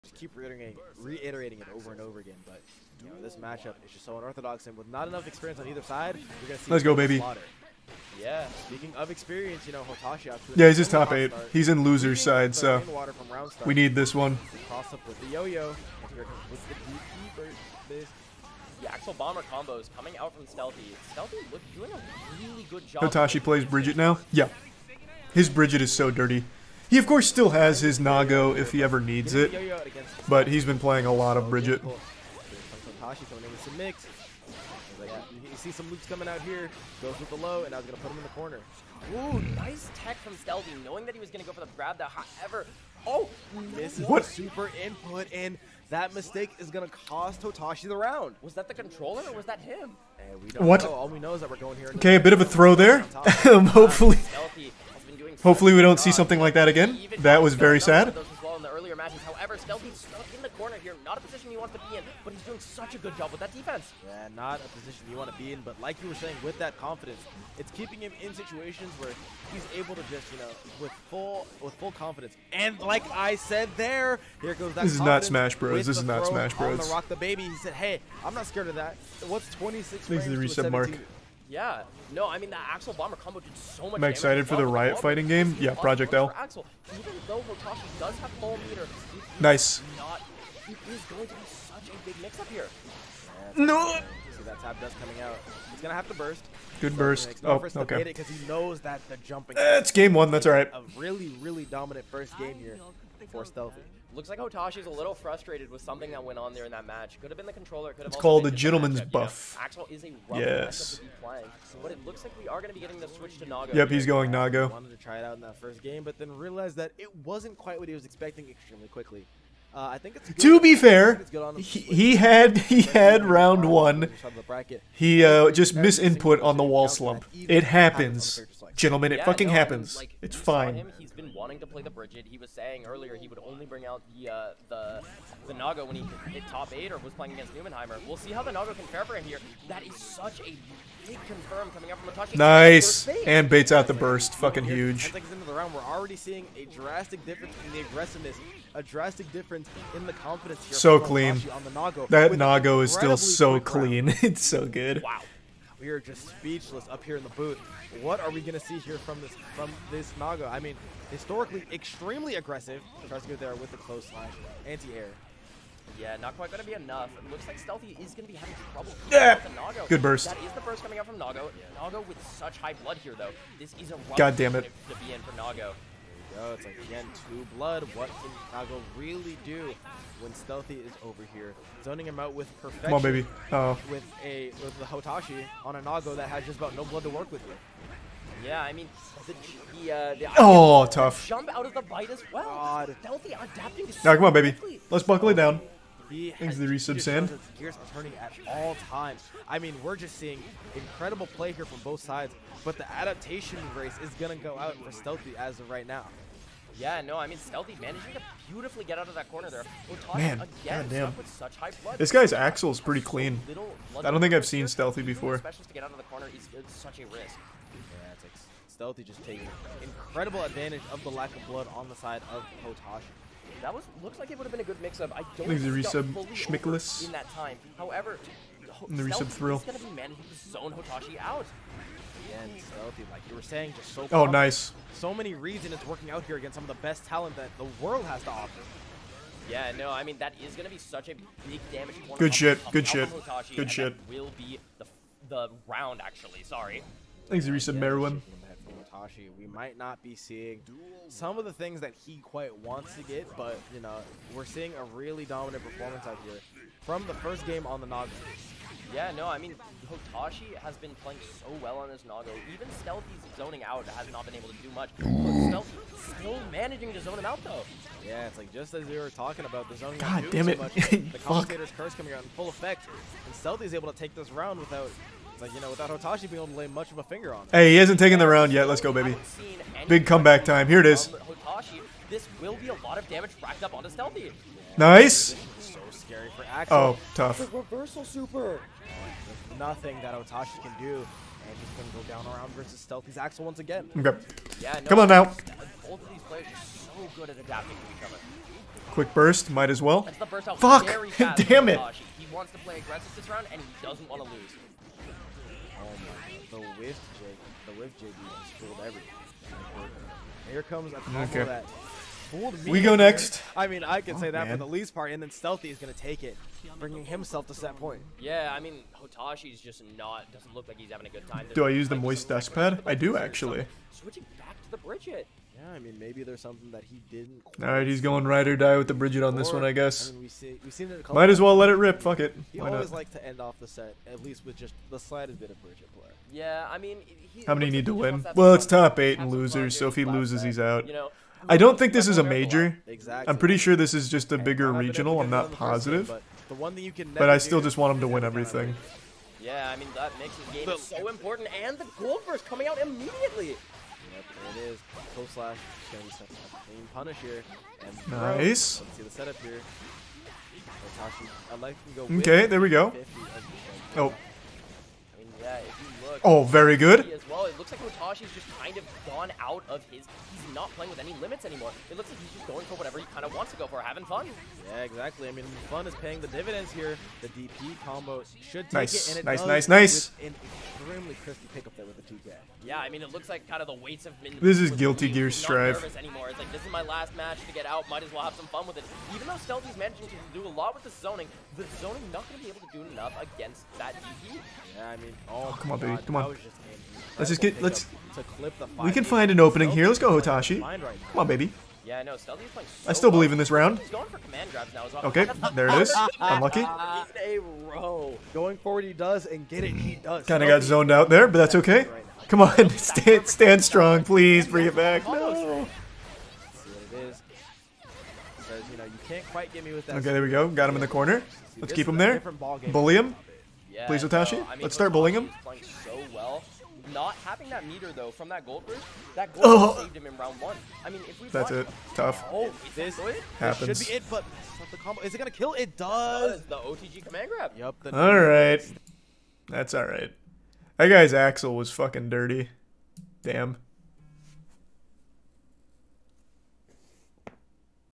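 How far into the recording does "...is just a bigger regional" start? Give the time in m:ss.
5:43.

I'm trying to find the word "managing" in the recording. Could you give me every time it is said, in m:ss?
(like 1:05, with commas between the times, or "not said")
3:27, 3:49, 4:26, 6:29.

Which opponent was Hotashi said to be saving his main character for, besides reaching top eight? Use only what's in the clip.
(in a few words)
Numenheimer.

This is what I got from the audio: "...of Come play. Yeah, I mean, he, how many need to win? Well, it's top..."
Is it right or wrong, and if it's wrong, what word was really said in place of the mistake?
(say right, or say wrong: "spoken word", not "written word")
wrong: "Bridget", not "Come".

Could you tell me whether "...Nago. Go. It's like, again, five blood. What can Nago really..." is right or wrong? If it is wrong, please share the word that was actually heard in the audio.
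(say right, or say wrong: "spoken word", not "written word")
wrong: "two", not "five".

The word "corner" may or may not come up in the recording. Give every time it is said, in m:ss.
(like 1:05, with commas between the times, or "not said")
0:38, 1:00, 3:29, 3:36, 7:00.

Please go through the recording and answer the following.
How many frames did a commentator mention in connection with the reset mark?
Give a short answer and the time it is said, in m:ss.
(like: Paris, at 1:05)
26, at 1:19.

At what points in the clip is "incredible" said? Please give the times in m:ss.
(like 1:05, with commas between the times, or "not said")
3:20, 3:39.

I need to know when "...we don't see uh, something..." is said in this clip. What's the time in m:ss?
0:55.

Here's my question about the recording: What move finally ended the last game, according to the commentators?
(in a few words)
OTG command grab.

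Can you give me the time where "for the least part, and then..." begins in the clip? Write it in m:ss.
5:14.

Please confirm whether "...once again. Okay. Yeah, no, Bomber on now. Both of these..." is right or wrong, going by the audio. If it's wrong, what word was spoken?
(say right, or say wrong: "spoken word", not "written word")
wrong: "Come", not "Bomber".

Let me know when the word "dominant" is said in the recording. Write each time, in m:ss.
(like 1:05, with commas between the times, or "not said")
1:41, 4:15.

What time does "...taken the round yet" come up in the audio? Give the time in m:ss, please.
4:37.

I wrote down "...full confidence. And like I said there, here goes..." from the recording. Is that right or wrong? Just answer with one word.
right.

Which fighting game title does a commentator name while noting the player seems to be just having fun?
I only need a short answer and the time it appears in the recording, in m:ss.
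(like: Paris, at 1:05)
Guilty Gear Strive, at 6:24.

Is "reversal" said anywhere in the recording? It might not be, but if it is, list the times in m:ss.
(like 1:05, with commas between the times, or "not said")
4:47.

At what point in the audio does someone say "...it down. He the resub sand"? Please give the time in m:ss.
3:15.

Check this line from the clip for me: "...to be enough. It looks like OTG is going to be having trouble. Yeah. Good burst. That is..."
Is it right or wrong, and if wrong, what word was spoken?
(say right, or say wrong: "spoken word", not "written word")
wrong: "Stealthy", not "OTG".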